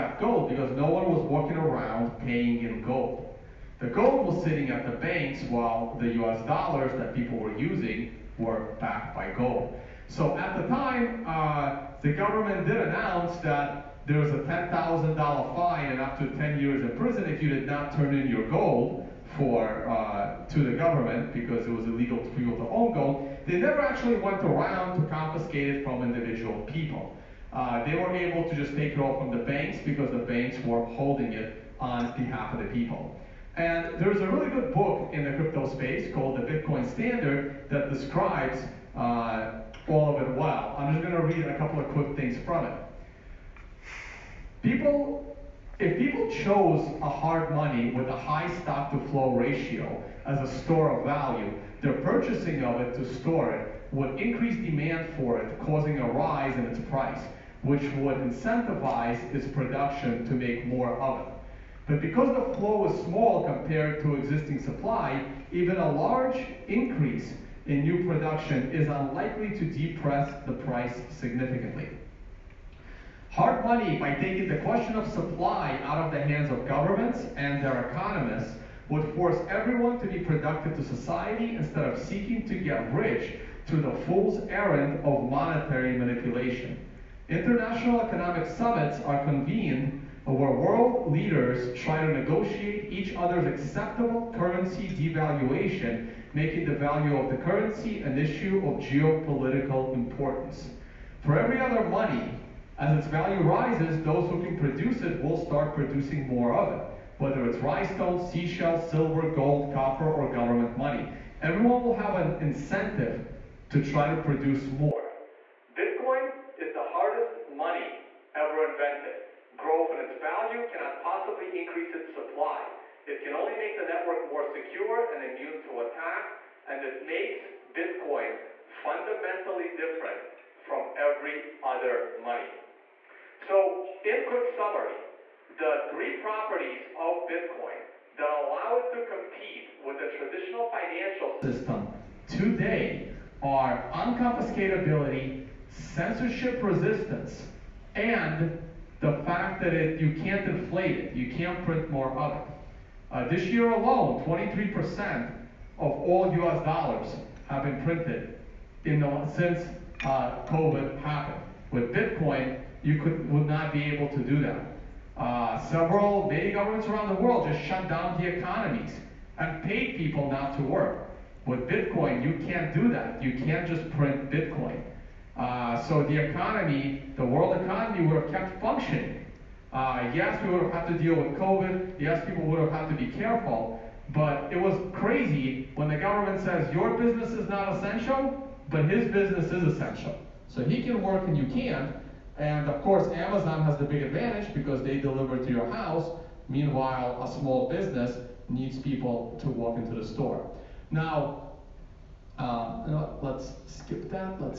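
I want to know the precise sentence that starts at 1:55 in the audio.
Bitcoin is the hardest money ever invented.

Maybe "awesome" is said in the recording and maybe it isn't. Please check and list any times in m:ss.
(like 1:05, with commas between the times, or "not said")
not said.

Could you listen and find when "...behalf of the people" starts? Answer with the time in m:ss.
0:32.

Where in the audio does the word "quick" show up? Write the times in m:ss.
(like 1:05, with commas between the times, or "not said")
0:41, 2:14.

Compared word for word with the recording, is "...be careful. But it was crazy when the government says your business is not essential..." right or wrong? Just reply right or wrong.
right.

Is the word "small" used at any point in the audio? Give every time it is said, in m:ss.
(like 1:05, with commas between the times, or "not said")
1:03, 3:17.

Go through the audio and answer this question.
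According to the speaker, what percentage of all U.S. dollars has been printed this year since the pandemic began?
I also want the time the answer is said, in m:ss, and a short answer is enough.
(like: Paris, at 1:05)
23%, at 2:34.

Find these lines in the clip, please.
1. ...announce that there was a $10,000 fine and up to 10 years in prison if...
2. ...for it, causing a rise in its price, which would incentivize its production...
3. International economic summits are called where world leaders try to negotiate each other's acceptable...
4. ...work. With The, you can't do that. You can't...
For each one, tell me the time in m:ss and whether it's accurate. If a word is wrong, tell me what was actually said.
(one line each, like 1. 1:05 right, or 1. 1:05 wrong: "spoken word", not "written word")
1. 0:12 right
2. 0:55 right
3. 1:27 wrong: "convened", not "called"
4. 2:50 wrong: "Bitcoin", not "The".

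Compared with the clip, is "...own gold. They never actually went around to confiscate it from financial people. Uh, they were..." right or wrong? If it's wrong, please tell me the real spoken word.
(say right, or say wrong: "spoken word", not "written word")
wrong: "individual", not "financial".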